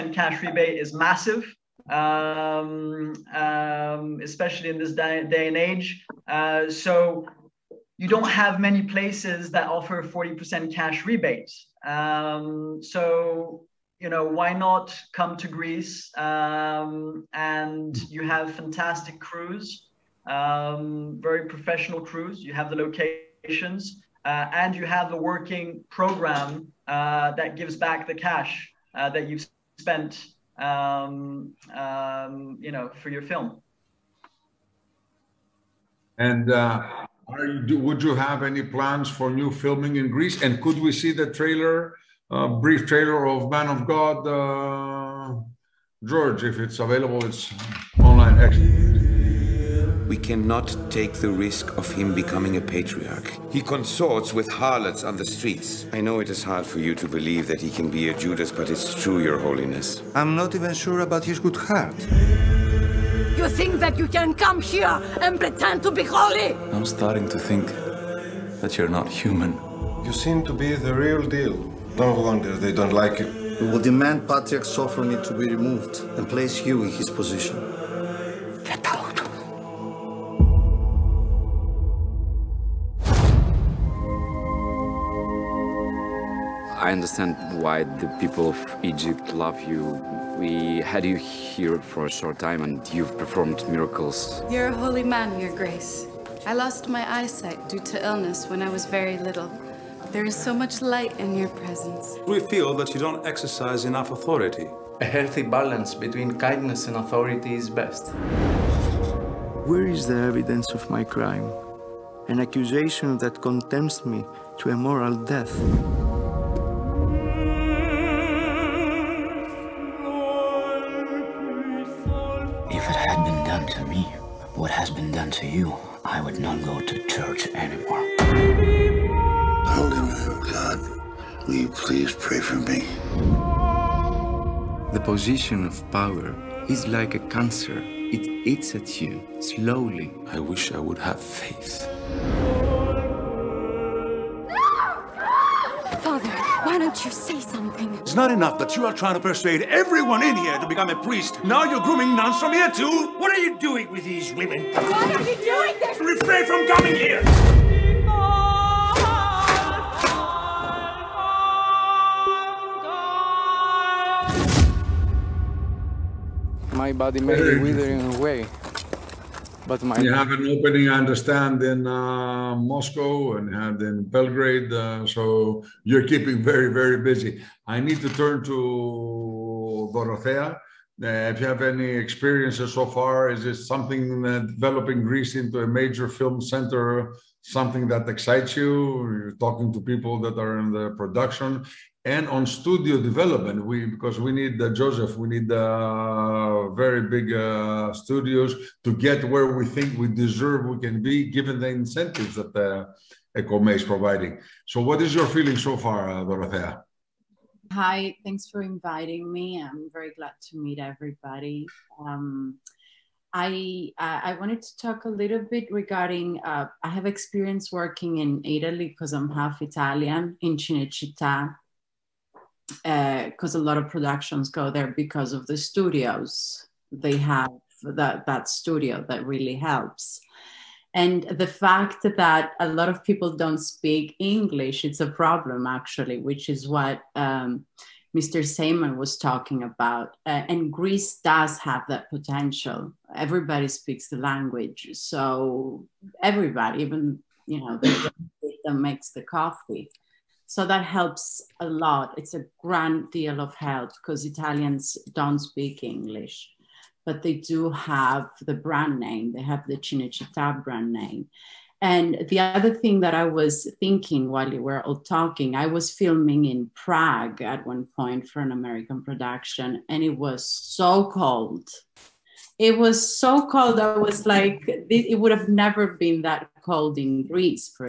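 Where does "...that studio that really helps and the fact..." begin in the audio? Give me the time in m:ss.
3:48.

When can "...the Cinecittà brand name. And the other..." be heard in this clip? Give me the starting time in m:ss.
4:19.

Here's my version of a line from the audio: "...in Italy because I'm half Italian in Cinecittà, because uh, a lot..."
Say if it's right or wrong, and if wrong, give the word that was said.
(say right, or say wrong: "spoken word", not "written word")
right.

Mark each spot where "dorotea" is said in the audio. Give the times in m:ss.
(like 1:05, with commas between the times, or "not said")
2:59, 3:26.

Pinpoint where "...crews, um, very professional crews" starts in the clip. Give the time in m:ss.
0:19.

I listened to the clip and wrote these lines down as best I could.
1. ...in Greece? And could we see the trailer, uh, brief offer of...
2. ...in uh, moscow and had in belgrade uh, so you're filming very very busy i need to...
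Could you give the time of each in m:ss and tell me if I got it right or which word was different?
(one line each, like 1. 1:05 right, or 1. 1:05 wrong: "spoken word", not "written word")
1. 0:39 wrong: "trailer", not "offer"
2. 2:51 wrong: "keeping", not "filming".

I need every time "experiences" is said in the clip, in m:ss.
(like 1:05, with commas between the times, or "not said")
3:02, 3:37.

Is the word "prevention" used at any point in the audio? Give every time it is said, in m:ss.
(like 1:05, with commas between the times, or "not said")
not said.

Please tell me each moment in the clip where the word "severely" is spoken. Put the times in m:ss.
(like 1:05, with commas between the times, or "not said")
not said.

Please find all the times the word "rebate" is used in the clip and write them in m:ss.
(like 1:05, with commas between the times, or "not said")
0:00, 0:11.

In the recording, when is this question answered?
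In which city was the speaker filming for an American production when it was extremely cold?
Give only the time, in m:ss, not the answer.
4:26.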